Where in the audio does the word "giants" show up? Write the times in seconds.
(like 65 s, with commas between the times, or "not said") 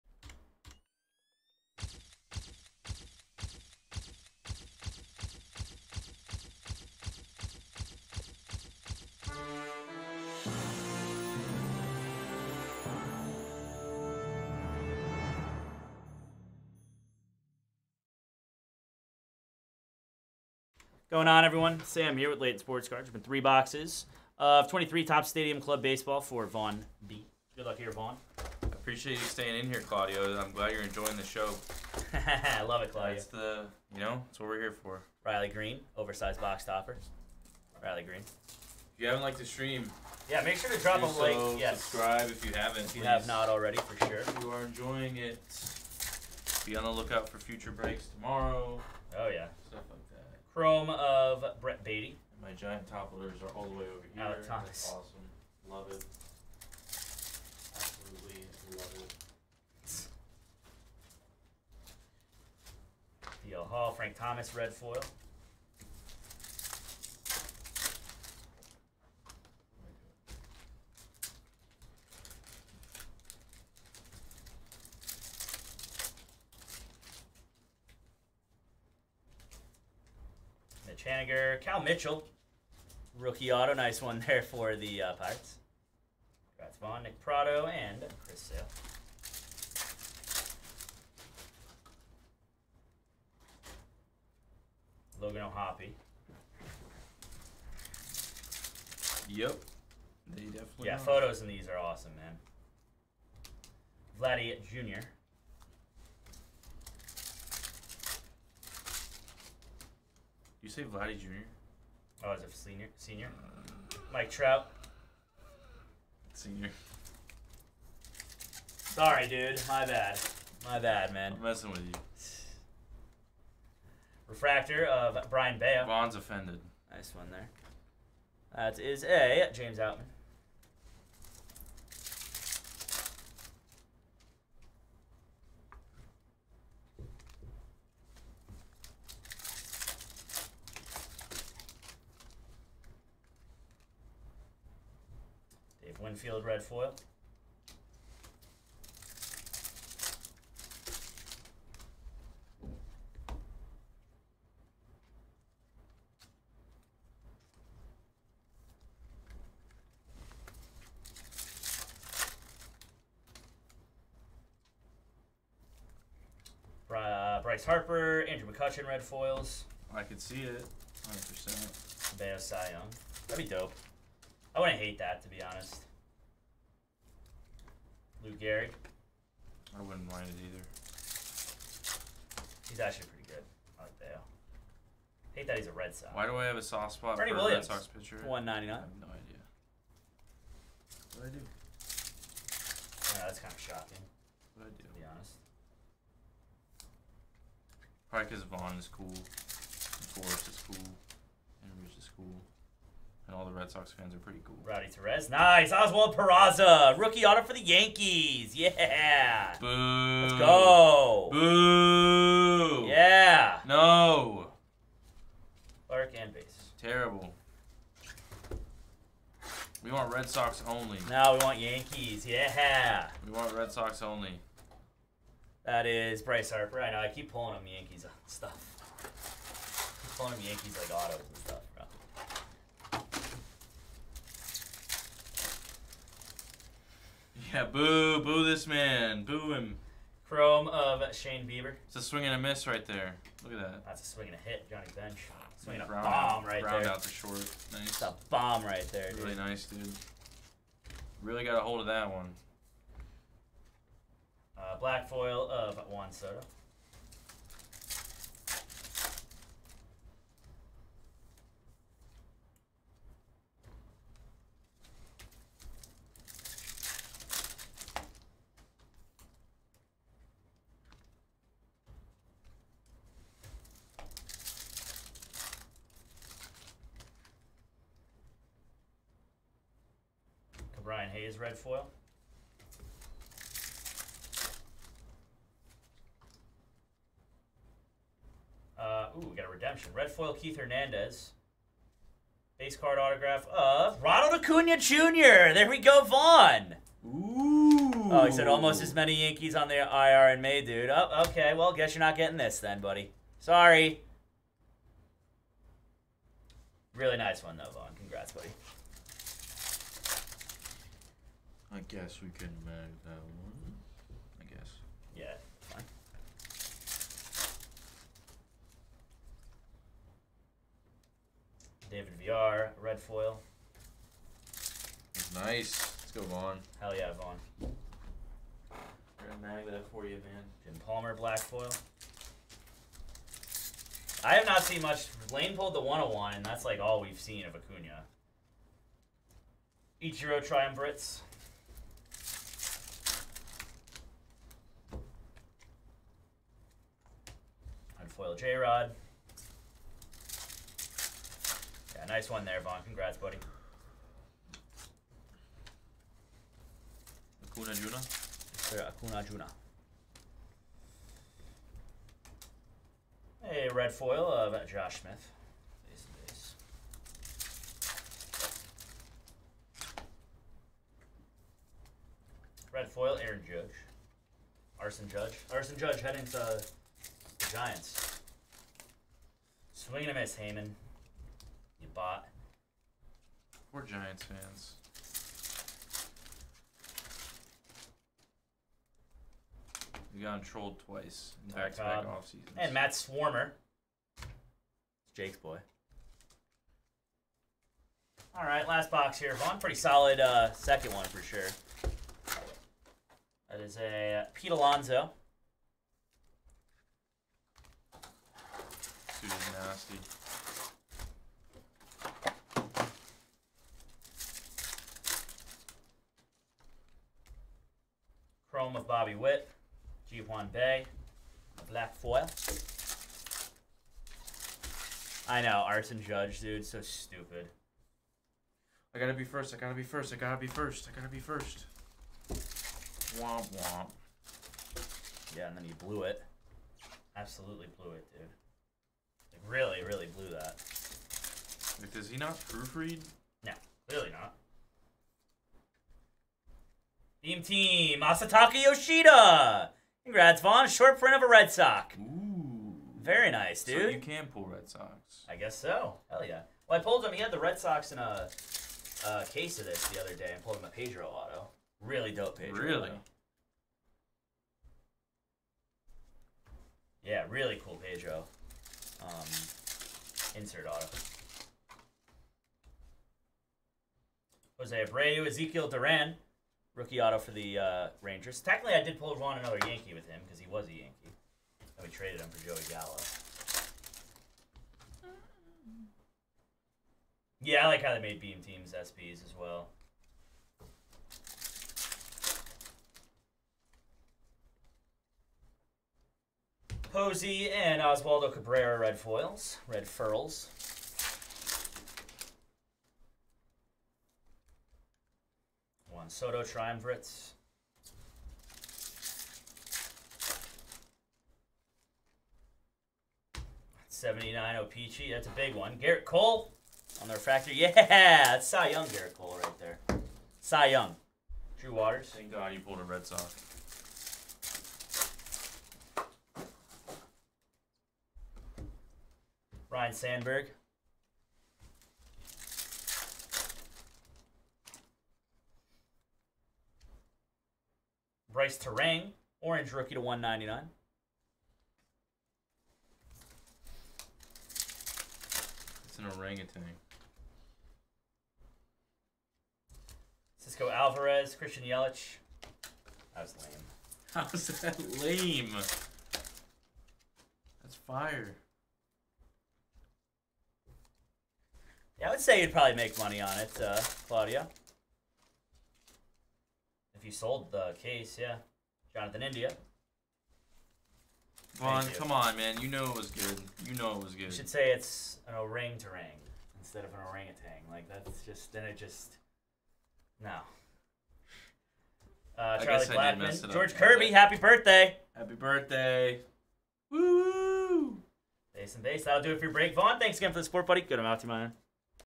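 52 s, 377 s, 383 s.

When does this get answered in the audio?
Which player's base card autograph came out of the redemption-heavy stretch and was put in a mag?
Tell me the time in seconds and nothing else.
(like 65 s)
294 s.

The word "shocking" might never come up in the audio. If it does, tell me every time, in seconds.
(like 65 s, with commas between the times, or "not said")
193 s.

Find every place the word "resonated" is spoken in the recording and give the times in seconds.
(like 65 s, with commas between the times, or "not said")
not said.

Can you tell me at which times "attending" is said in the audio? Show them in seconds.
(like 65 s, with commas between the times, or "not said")
not said.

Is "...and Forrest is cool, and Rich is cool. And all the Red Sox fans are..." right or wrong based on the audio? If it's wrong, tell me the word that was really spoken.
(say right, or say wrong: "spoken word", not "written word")
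right.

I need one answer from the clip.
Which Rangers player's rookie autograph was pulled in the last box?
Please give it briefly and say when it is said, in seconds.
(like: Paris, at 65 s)
Ezekiel Duran, at 475 s.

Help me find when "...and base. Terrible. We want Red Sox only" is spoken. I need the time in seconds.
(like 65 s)
216 s.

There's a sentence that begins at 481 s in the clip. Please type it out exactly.
And we traded him for Joey Gallo.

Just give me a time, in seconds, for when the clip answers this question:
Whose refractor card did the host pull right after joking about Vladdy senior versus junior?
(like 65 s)
125 s.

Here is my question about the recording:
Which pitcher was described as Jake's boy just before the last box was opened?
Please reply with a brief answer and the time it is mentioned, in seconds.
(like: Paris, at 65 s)
Matt Swarmer, at 392 s.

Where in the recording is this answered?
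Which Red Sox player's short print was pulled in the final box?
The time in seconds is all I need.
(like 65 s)
448 s.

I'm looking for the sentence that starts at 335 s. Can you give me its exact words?
Lane pulled the 101, and that's like all we've seen of Acuna.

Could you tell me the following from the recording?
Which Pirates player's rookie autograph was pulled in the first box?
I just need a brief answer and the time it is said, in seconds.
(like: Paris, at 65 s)
Cal Mitchell, at 81 s.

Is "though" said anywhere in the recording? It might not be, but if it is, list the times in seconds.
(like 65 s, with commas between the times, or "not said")
307 s.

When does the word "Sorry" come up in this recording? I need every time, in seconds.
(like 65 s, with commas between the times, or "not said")
118 s, 303 s.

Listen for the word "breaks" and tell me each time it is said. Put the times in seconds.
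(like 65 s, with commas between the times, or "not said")
47 s, 589 s.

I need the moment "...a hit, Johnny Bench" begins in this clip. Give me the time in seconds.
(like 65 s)
244 s.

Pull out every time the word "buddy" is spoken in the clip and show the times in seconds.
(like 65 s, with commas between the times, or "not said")
302 s, 353 s, 590 s.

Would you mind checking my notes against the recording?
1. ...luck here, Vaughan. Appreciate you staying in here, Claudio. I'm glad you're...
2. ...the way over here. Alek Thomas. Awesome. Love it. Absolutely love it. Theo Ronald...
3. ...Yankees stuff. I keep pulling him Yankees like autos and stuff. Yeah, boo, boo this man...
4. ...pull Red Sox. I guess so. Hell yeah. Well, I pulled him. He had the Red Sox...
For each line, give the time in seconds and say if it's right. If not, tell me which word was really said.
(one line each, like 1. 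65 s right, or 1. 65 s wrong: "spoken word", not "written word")
1. 27 s right
2. 53 s wrong: "Hall", not "Ronald"
3. 227 s right
4. 454 s right.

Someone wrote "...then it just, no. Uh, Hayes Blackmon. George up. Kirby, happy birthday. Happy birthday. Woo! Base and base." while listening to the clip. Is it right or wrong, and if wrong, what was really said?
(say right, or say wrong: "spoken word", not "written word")
wrong: "Charlie", not "Hayes".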